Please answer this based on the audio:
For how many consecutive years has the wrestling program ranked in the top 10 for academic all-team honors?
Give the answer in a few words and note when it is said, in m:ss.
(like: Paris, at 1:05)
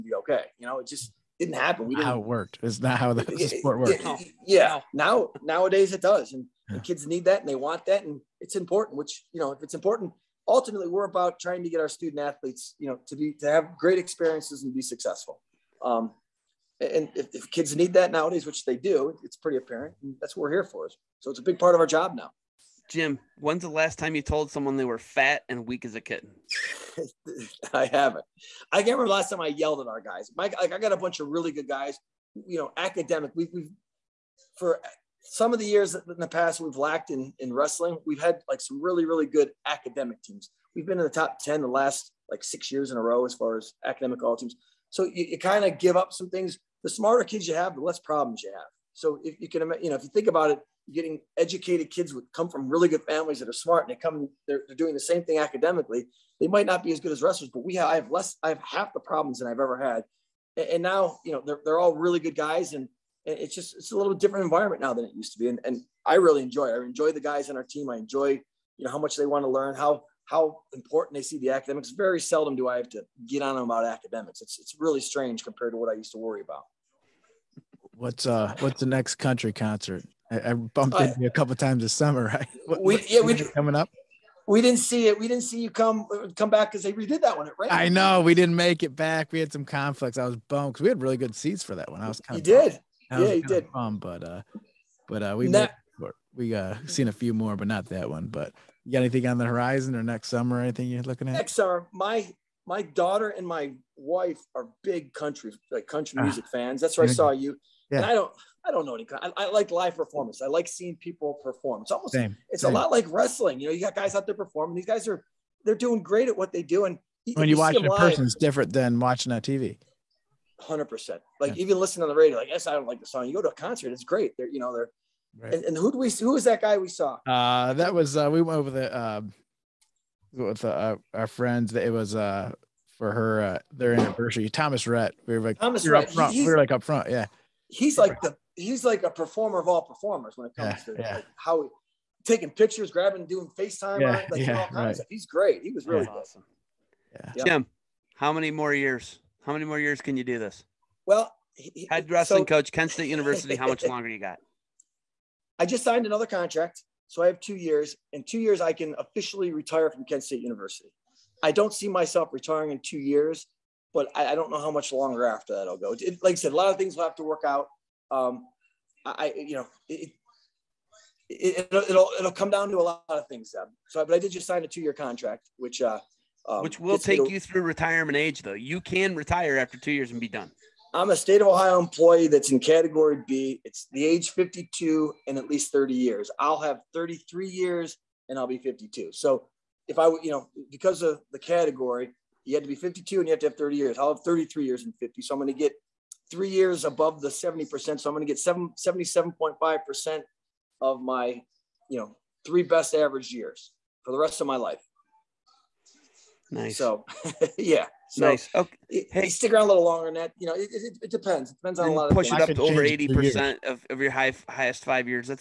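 6, at 0:42.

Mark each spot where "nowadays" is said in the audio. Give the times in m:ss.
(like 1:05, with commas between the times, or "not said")
0:05, 0:18.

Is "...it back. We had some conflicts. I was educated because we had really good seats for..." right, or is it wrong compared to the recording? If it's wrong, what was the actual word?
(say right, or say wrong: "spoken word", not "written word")
wrong: "bummed", not "educated".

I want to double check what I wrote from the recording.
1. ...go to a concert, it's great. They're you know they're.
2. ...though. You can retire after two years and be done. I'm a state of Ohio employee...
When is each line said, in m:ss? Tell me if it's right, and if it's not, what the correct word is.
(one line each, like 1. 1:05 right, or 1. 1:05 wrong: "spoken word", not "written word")
1. 2:03 right
2. 2:58 right.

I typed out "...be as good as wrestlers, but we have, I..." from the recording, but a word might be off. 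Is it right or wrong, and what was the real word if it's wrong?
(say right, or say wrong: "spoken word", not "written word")
right.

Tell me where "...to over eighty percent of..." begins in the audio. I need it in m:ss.
3:32.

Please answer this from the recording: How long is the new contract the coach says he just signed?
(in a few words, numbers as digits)
2 years.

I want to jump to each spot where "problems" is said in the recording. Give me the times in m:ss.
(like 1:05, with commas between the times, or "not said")
0:47, 0:58.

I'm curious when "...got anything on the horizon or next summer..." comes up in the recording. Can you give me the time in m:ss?
1:38.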